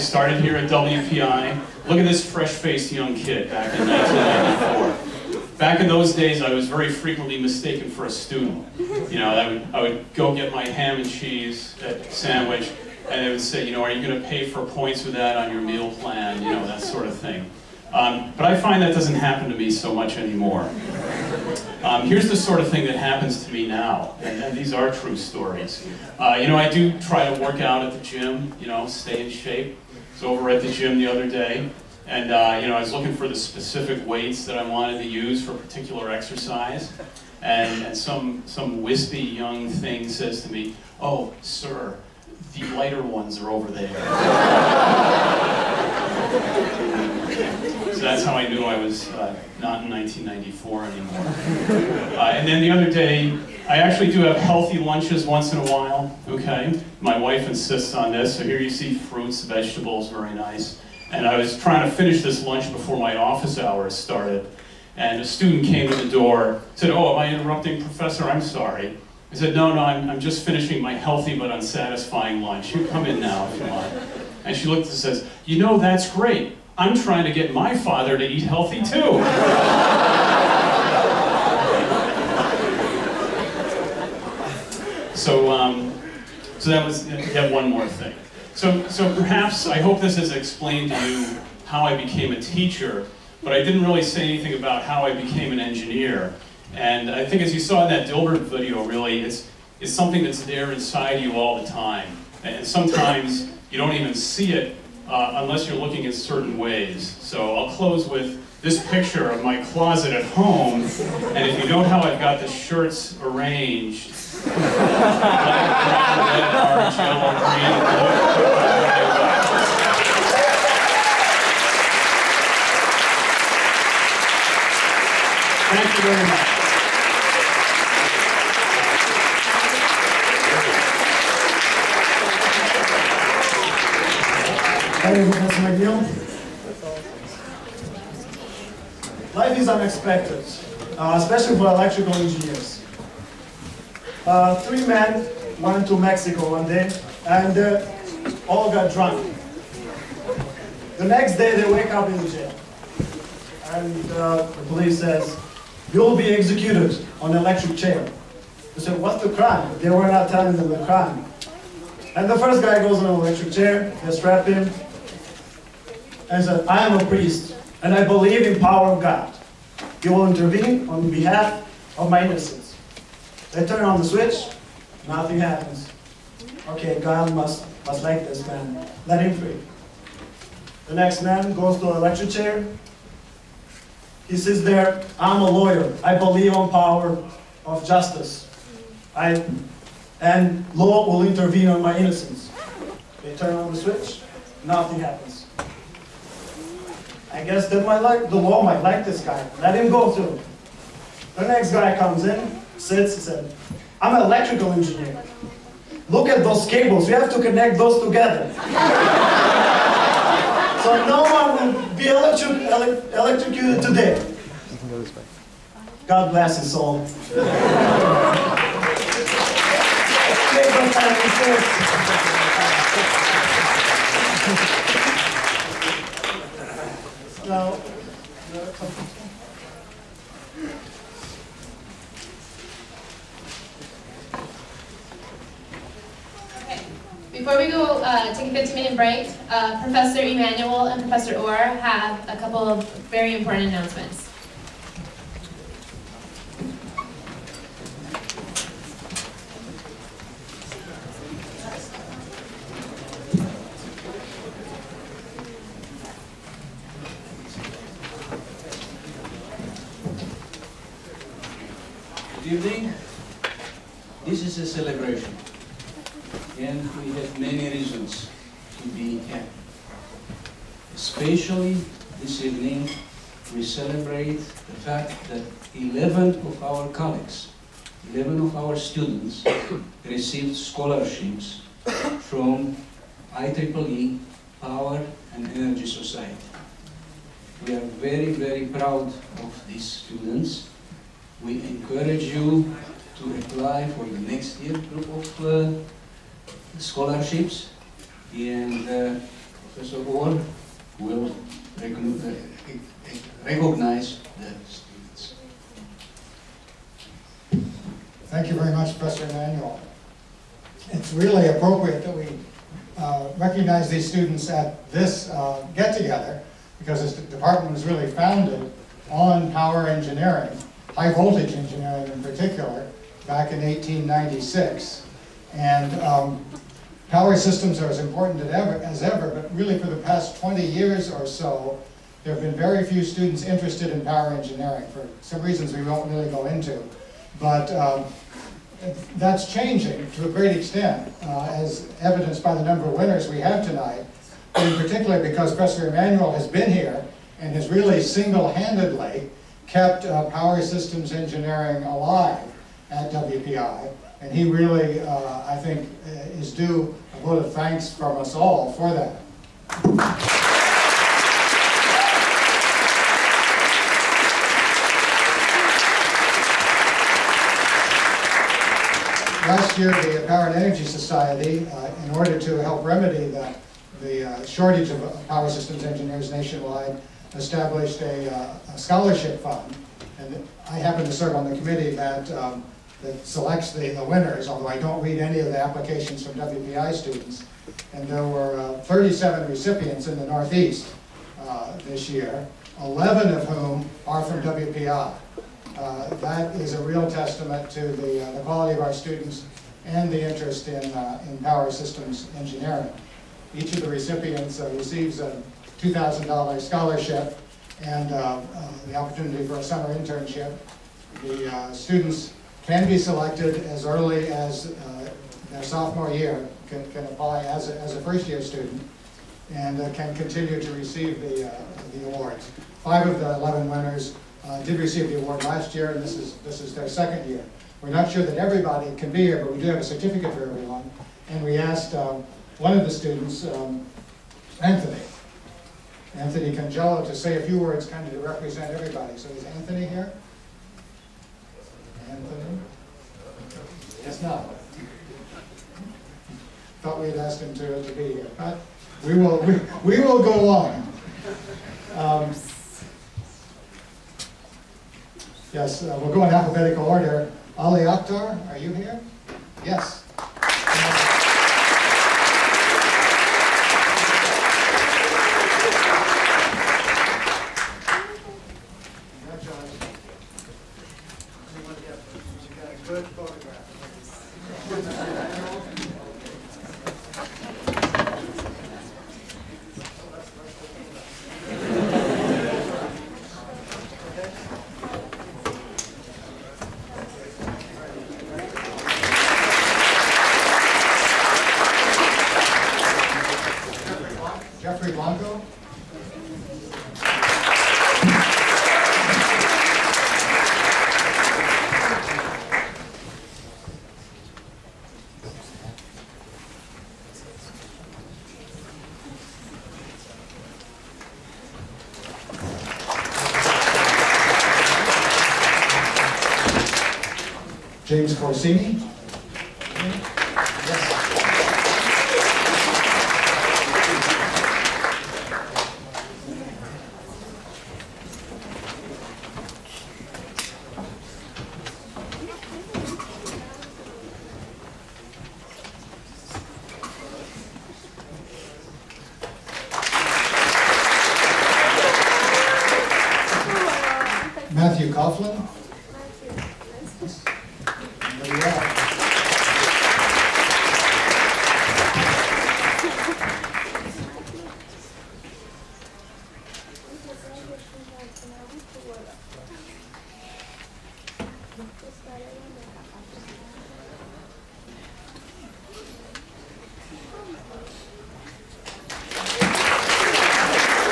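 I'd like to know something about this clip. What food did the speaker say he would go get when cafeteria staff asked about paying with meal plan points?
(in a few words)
ham and cheese sandwich.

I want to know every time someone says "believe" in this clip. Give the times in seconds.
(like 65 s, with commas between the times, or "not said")
168 s, 186 s.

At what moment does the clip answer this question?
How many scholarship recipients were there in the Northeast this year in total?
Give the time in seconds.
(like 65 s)
388 s.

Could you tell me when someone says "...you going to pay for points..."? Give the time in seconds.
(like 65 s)
13 s.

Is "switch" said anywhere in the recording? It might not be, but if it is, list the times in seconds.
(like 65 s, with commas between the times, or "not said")
174 s, 193 s.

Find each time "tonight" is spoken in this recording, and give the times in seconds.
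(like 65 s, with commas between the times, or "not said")
343 s.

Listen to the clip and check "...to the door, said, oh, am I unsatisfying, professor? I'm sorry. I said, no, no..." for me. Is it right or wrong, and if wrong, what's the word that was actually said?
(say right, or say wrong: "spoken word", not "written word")
wrong: "interrupting", not "unsatisfying".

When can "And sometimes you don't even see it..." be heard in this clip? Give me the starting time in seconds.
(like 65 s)
102 s.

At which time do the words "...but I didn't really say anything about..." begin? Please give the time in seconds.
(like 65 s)
93 s.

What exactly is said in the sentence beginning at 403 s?
Each of the recipients uh, receives a $2,000 scholarship and uh, the opportunity for a summer internship.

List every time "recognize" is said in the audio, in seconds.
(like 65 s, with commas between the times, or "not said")
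303 s, 313 s.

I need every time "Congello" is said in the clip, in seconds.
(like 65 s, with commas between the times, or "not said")
436 s.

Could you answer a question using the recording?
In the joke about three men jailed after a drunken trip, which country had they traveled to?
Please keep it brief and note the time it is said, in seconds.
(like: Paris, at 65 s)
Mexico, at 145 s.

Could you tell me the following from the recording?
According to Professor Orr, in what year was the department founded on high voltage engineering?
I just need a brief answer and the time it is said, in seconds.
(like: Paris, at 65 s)
1896, at 323 s.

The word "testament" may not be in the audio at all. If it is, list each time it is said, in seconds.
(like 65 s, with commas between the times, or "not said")
397 s.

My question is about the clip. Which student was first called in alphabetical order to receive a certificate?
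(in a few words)
Ali Akhtar.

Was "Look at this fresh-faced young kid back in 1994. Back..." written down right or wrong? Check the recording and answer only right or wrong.
right.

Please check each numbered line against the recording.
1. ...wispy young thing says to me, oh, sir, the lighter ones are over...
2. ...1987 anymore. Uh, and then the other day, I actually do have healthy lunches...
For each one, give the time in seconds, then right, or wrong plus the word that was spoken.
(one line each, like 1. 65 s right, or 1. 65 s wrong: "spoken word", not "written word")
1. 38 s right
2. 49 s wrong: "1994", not "1987".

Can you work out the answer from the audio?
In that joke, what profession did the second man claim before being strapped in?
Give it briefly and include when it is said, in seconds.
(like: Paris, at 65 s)
lawyer, at 185 s.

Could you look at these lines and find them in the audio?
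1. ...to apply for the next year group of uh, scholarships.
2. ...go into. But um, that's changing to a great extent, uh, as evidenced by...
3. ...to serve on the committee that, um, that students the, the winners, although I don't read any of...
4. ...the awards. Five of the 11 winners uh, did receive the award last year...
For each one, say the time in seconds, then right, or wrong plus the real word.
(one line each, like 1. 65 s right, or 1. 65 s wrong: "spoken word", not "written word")
1. 293 s right
2. 336 s right
3. 381 s wrong: "selects", not "students"
4. 421 s right.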